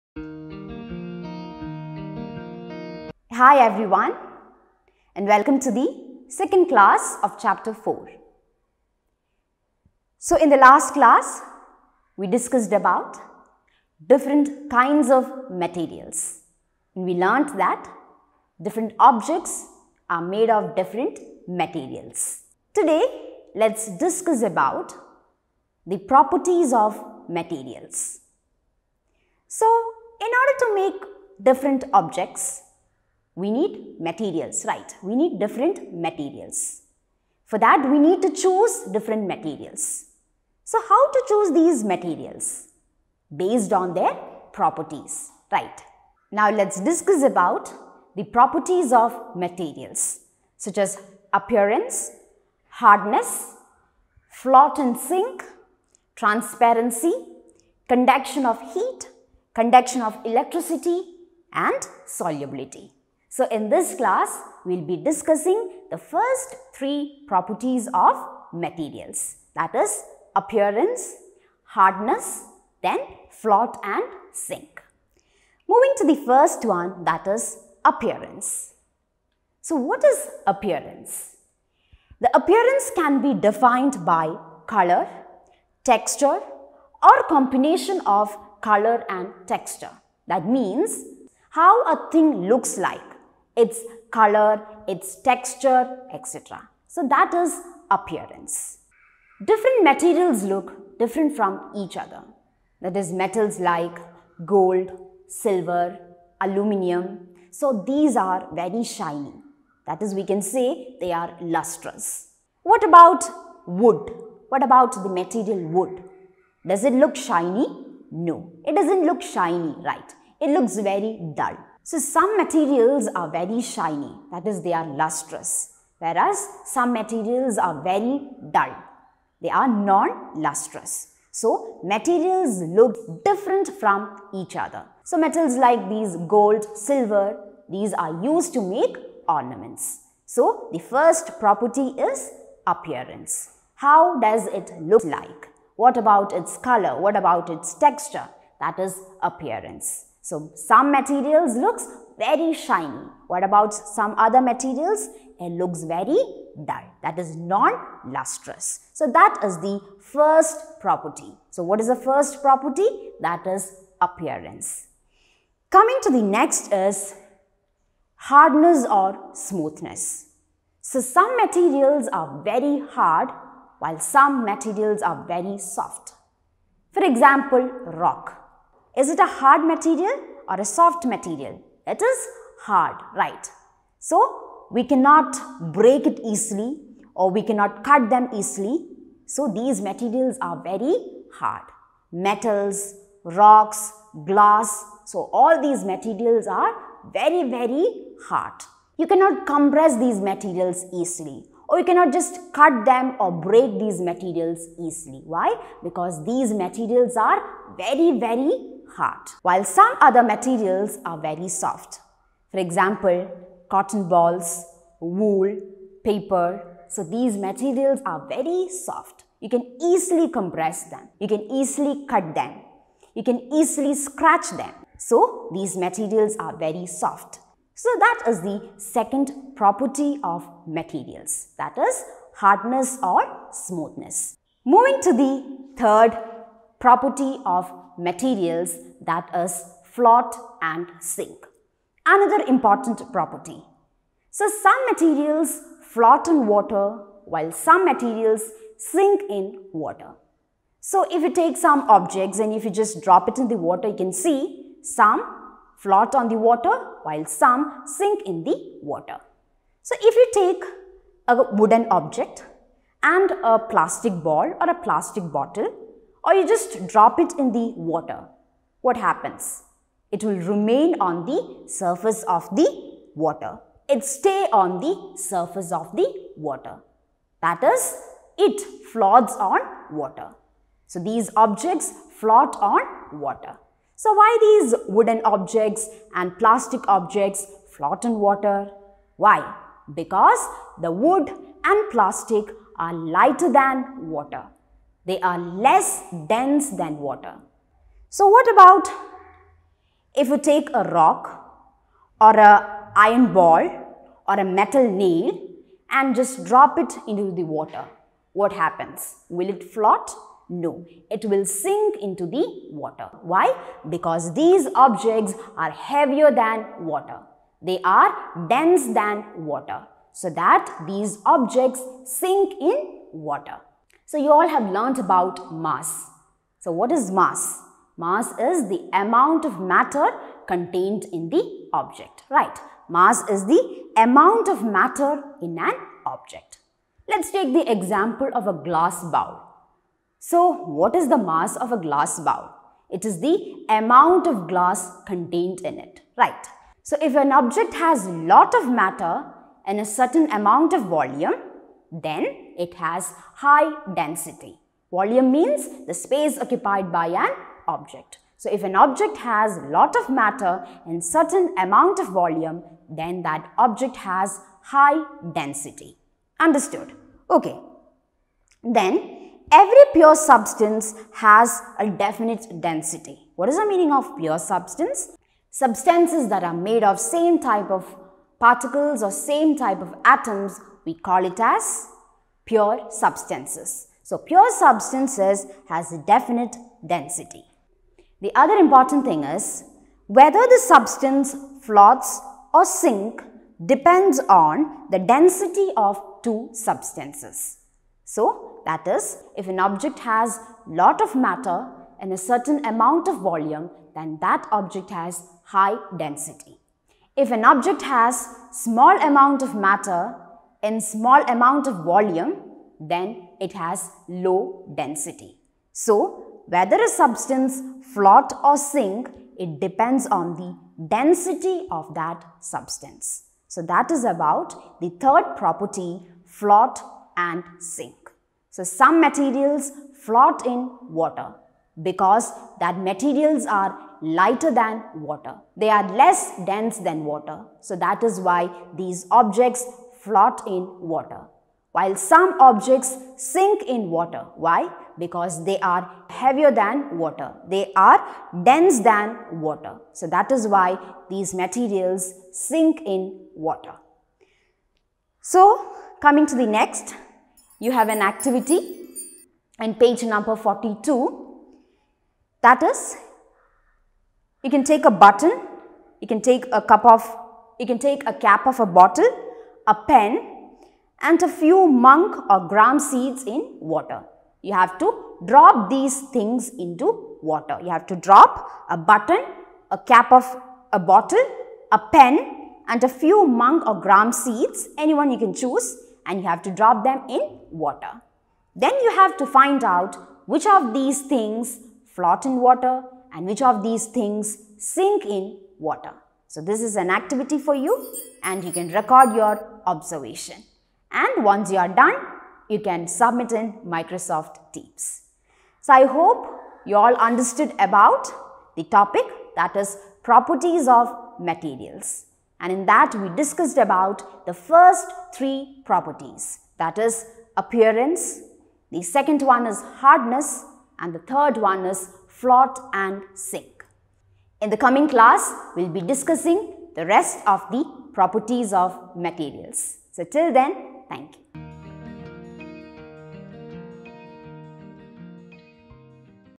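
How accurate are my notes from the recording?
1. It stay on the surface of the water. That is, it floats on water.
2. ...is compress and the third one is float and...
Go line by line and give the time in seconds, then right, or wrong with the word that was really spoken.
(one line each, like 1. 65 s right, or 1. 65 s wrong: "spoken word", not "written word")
1. 273 s right
2. 519 s wrong: "hardness", not "compress".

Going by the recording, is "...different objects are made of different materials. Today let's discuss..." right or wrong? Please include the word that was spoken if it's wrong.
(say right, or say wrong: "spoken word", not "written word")
right.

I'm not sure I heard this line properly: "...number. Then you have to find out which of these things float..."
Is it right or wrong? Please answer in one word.
wrong.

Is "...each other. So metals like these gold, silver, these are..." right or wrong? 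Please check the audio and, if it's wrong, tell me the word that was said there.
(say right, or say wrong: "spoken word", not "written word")
right.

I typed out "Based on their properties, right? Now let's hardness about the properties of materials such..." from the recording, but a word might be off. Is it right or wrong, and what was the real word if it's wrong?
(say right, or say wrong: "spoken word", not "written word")
wrong: "discuss", not "hardness".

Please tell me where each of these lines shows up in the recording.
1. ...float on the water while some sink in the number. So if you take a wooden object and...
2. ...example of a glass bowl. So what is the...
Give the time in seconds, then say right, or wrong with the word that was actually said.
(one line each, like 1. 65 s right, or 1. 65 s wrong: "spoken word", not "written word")
1. 255 s wrong: "water", not "number"
2. 337 s right.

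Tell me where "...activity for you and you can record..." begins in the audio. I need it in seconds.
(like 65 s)
496 s.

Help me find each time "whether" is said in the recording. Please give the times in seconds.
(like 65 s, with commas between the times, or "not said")
390 s, 416 s.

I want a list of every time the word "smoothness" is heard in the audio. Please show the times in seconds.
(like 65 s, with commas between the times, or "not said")
169 s, 233 s.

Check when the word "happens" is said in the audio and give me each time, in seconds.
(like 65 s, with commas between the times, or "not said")
268 s, 308 s.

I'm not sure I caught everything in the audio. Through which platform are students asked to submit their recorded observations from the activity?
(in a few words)
Microsoft Teams.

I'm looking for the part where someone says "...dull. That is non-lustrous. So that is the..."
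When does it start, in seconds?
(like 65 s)
156 s.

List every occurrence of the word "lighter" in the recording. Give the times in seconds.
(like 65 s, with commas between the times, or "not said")
292 s, 434 s.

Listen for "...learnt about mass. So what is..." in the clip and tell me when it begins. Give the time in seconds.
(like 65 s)
324 s.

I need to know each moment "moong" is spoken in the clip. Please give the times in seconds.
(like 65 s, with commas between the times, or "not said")
471 s, 483 s.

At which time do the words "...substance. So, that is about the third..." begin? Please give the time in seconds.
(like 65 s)
422 s.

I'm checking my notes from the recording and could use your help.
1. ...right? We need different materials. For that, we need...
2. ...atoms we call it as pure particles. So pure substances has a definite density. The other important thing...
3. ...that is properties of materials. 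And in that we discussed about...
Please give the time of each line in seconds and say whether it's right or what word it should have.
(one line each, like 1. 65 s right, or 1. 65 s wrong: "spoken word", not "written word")
1. 34 s right
2. 380 s wrong: "substances", not "particles"
3. 509 s right.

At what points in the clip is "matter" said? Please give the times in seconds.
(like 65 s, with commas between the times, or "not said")
329 s, 334 s, 348 s, 360 s, 401 s, 409 s.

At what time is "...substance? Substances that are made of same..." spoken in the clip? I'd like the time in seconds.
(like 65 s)
374 s.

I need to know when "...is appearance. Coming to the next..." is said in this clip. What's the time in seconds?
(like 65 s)
163 s.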